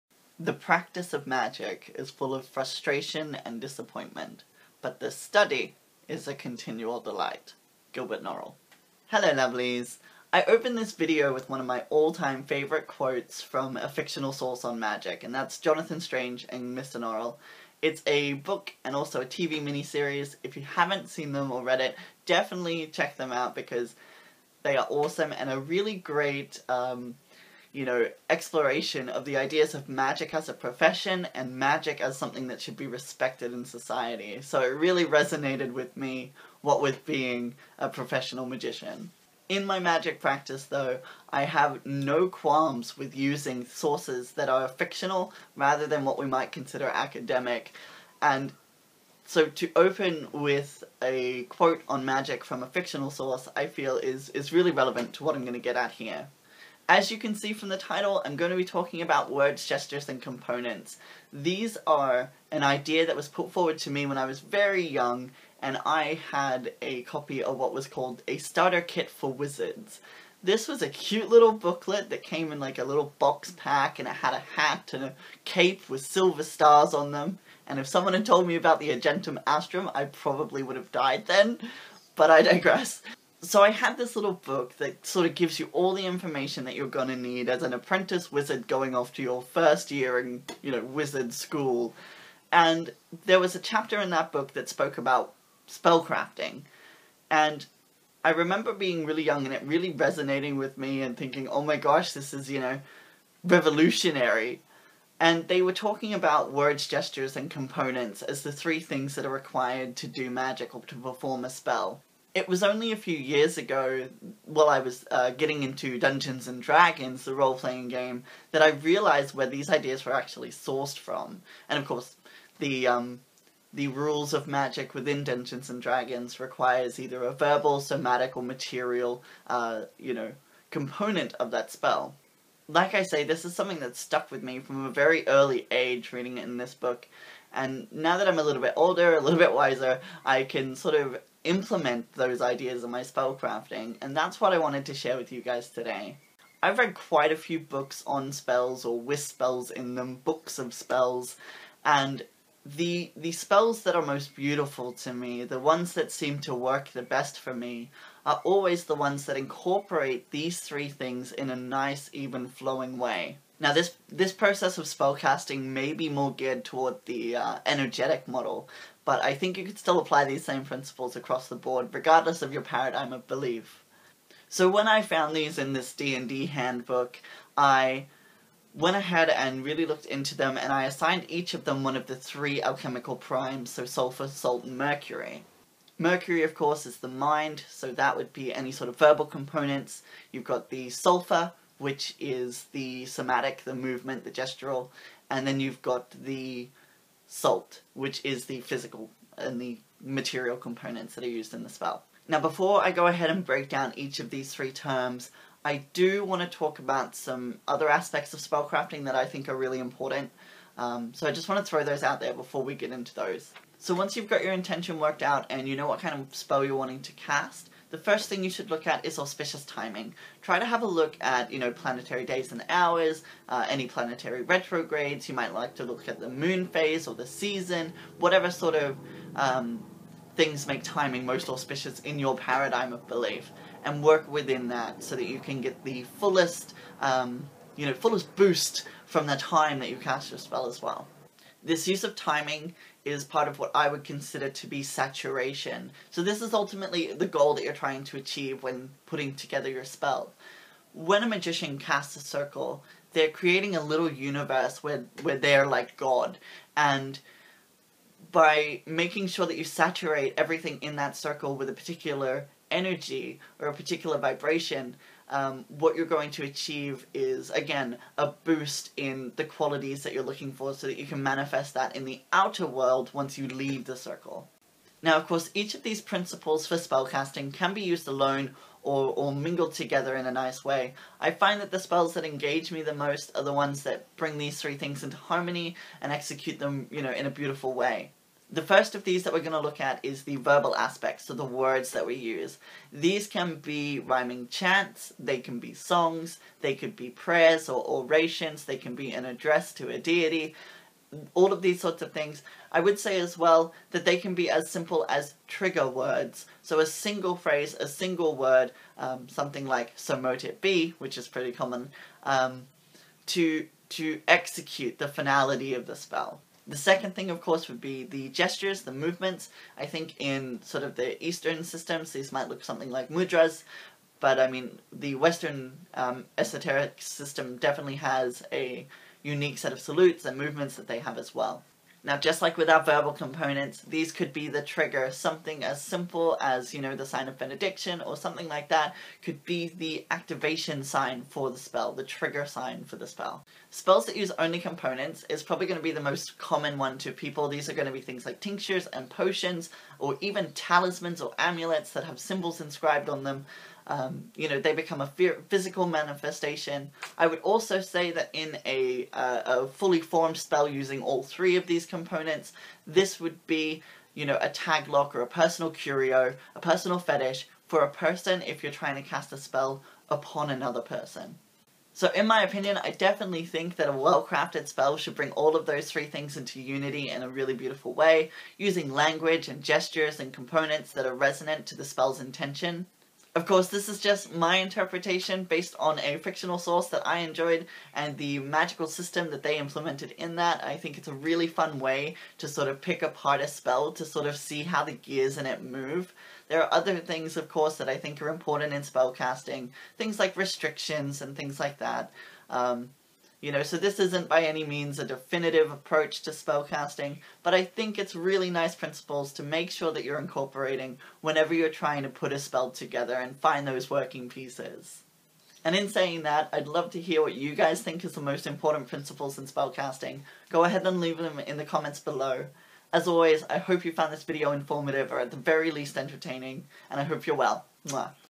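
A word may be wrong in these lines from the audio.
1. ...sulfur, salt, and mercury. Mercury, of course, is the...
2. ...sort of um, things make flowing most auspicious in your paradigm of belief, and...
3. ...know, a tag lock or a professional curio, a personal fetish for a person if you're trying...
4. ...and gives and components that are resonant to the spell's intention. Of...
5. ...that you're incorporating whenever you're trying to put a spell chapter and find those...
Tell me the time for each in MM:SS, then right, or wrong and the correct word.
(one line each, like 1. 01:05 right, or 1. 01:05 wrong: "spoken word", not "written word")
1. 03:03 right
2. 03:48 wrong: "timing", not "flowing"
3. 06:04 wrong: "personal", not "professional"
4. 06:19 wrong: "gestures", not "gives"
5. 06:49 wrong: "together", not "chapter".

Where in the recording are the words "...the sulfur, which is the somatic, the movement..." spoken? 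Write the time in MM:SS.
03:10.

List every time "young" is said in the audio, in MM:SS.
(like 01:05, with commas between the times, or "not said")
01:04, 01:39.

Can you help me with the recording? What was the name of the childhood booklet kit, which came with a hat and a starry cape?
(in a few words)
starter kit for wizards.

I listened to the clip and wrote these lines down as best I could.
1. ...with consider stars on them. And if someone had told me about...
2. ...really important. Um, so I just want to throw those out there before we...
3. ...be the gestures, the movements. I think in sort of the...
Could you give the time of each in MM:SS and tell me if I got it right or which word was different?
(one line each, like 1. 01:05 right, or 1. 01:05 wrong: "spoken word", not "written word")
1. 01:15 wrong: "silver", not "consider"
2. 03:29 right
3. 05:17 right.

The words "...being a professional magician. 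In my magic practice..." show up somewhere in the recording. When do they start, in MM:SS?
00:37.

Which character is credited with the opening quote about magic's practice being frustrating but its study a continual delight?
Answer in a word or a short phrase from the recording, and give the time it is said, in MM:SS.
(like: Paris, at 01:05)
Gilbert Norrell, at 00:07.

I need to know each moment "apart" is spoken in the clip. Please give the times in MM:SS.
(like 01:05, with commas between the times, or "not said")
06:33.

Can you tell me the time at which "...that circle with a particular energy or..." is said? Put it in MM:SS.
04:20.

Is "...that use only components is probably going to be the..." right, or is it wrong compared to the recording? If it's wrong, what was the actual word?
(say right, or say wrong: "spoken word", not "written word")
right.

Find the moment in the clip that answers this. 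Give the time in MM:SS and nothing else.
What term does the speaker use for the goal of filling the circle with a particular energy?
04:04.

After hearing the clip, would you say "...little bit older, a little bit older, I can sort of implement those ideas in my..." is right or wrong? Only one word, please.
wrong.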